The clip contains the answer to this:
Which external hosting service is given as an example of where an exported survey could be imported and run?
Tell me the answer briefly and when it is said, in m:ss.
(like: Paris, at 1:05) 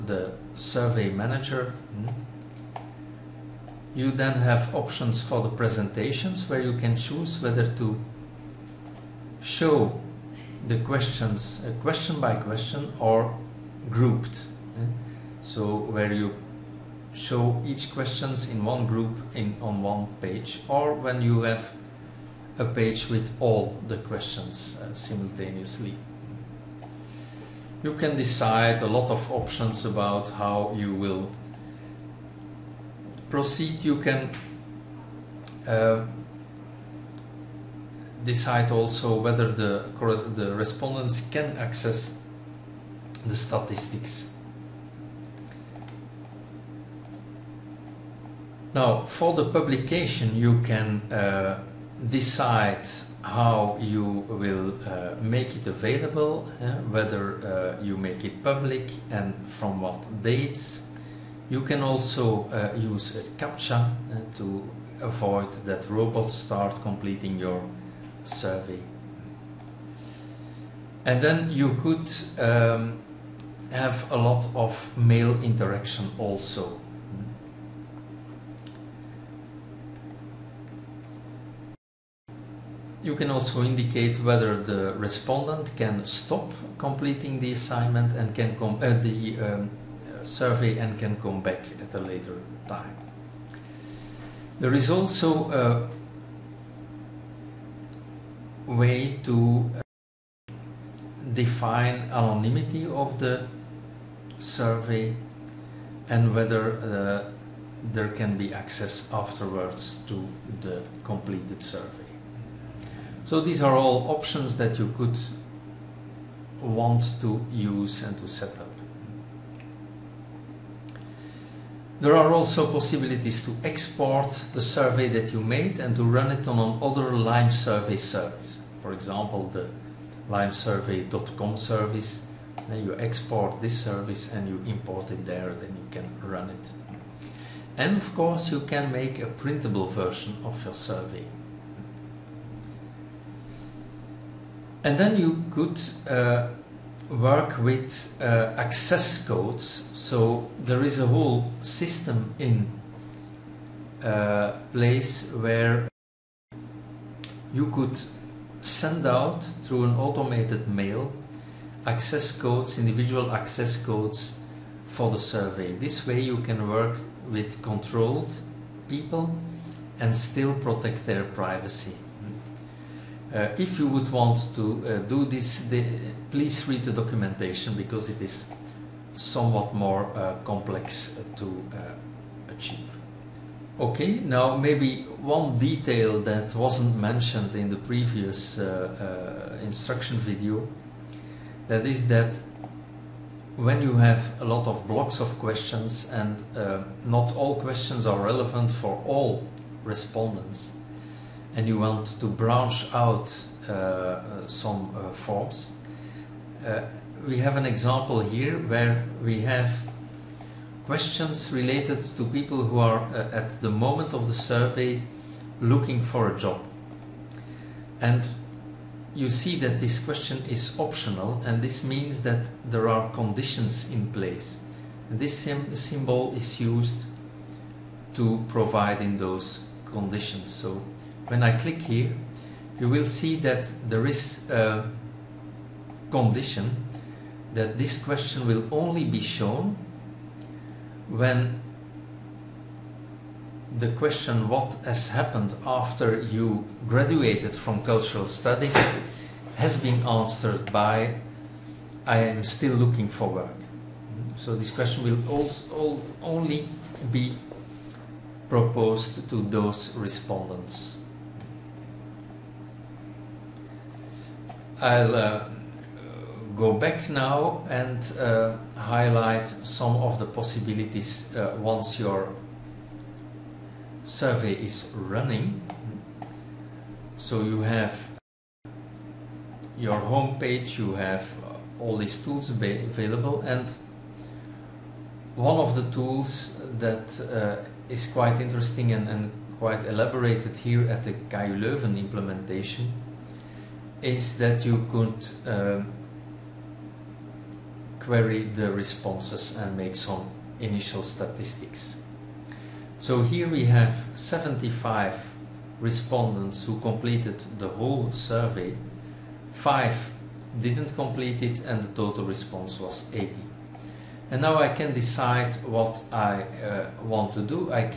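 limesurvey.com, at 2:10.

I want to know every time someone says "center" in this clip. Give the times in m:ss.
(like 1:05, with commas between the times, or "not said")
not said.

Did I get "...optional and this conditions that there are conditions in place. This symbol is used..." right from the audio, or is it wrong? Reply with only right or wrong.
wrong.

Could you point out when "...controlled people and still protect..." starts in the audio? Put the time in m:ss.
2:47.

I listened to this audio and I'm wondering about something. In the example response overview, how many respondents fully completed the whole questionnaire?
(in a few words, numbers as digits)
75.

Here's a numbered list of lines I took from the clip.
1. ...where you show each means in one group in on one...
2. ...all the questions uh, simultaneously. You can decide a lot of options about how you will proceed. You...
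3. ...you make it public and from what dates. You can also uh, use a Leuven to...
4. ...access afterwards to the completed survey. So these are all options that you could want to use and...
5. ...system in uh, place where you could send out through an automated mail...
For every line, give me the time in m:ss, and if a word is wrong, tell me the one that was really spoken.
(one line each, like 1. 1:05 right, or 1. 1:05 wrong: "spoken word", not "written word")
1. 0:15 wrong: "questions", not "means"
2. 0:23 right
3. 0:57 wrong: "CAPTCHA", not "Leuven"
4. 1:48 right
5. 2:31 right.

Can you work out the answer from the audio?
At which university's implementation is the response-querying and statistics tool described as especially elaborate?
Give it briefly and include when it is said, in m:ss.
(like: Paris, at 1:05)
KU Leuven, at 4:51.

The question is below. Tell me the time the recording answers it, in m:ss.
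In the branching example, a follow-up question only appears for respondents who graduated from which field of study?
4:07.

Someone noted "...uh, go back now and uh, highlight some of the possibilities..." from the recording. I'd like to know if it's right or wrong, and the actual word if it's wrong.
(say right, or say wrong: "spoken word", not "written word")
right.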